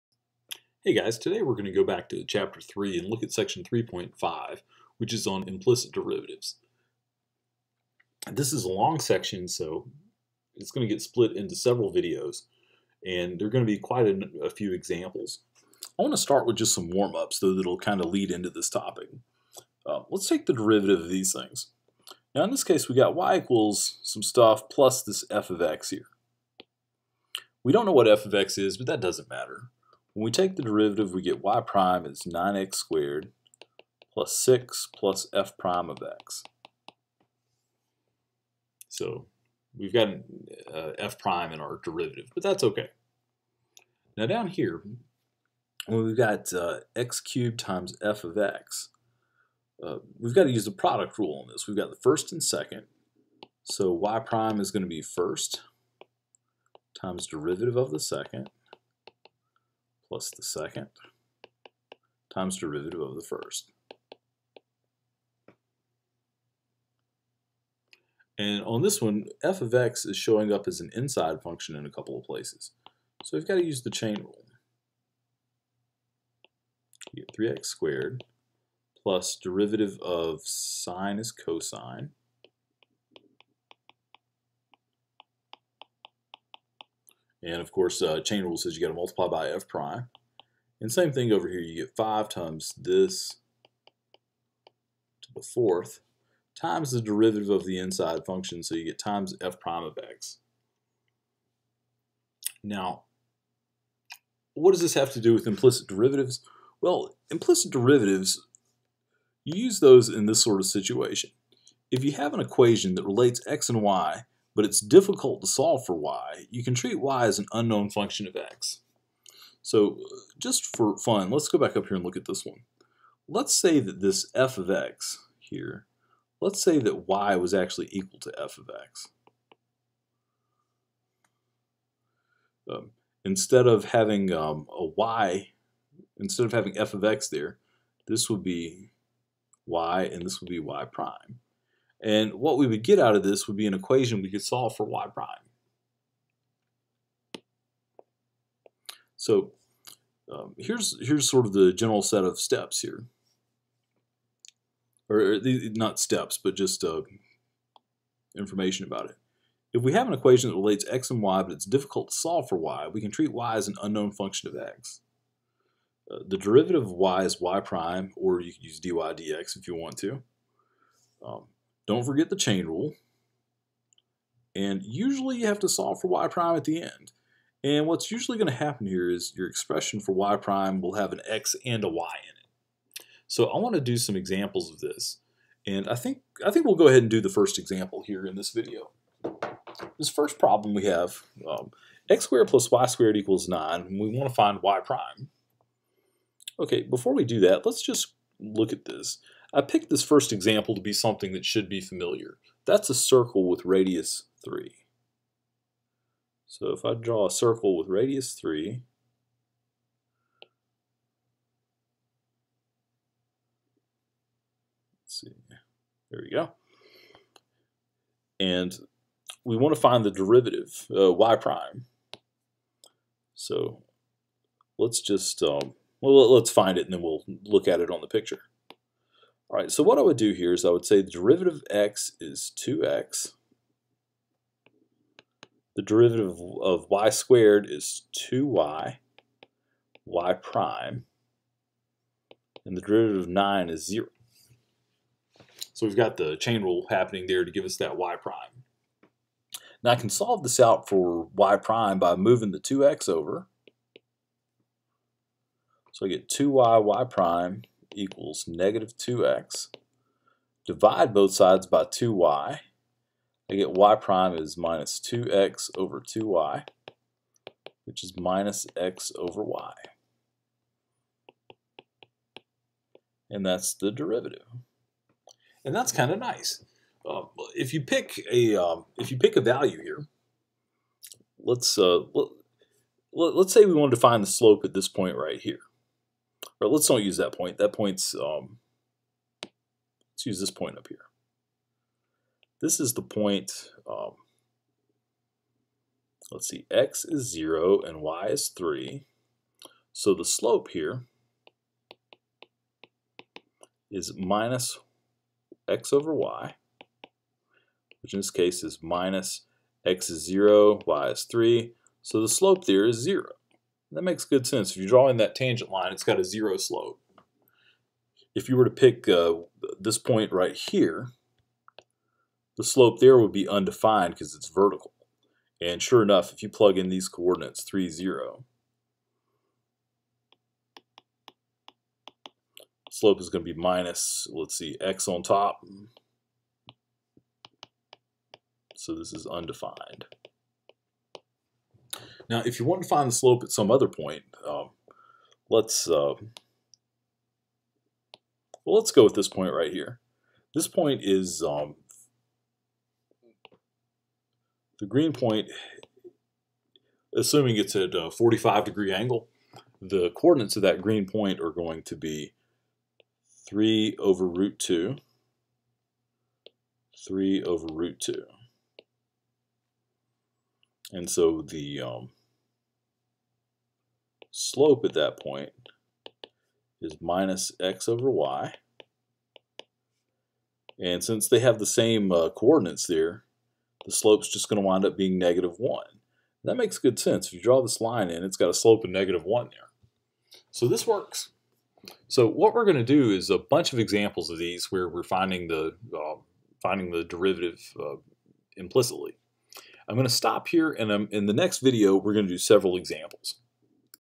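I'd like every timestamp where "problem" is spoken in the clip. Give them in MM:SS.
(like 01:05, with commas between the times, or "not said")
03:10.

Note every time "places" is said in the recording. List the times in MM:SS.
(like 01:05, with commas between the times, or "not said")
01:12.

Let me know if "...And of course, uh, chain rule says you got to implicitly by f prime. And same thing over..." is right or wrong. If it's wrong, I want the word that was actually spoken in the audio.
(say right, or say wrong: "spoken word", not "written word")
wrong: "multiply", not "implicitly".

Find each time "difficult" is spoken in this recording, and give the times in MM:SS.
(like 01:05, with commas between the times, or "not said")
01:54, 02:41.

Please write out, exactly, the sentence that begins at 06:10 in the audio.
And so the um, slope at that point is minus x over y.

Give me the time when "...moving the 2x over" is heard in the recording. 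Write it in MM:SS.
04:12.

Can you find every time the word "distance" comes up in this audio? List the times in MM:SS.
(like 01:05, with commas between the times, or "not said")
not said.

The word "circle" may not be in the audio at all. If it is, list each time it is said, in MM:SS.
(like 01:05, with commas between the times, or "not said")
03:22, 03:27.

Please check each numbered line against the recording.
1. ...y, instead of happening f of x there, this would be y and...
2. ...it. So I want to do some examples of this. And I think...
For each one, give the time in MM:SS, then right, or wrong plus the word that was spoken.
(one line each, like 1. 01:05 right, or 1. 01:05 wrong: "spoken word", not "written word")
1. 02:14 wrong: "having", not "happening"
2. 03:02 right.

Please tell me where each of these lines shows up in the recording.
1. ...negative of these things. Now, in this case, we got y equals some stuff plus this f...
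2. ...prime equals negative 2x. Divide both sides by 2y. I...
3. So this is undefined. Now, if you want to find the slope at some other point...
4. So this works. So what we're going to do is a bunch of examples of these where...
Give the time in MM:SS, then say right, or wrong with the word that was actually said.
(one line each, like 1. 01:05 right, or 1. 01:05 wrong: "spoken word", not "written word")
1. 00:20 wrong: "derivative", not "negative"
2. 04:17 right
3. 05:38 right
4. 06:30 right.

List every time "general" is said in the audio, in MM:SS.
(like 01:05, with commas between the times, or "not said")
02:31.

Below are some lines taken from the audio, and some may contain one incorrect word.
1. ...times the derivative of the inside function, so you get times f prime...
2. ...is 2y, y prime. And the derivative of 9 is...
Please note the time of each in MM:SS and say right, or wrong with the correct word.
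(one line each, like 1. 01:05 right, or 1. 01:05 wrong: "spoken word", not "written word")
1. 01:36 right
2. 03:57 right.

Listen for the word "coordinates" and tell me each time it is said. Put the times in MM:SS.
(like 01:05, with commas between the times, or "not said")
05:27, 06:00, 06:22.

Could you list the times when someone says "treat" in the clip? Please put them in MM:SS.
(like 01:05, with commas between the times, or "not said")
01:56, 02:43.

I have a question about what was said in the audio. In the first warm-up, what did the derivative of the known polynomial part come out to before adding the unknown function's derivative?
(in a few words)
9x squared plus 6.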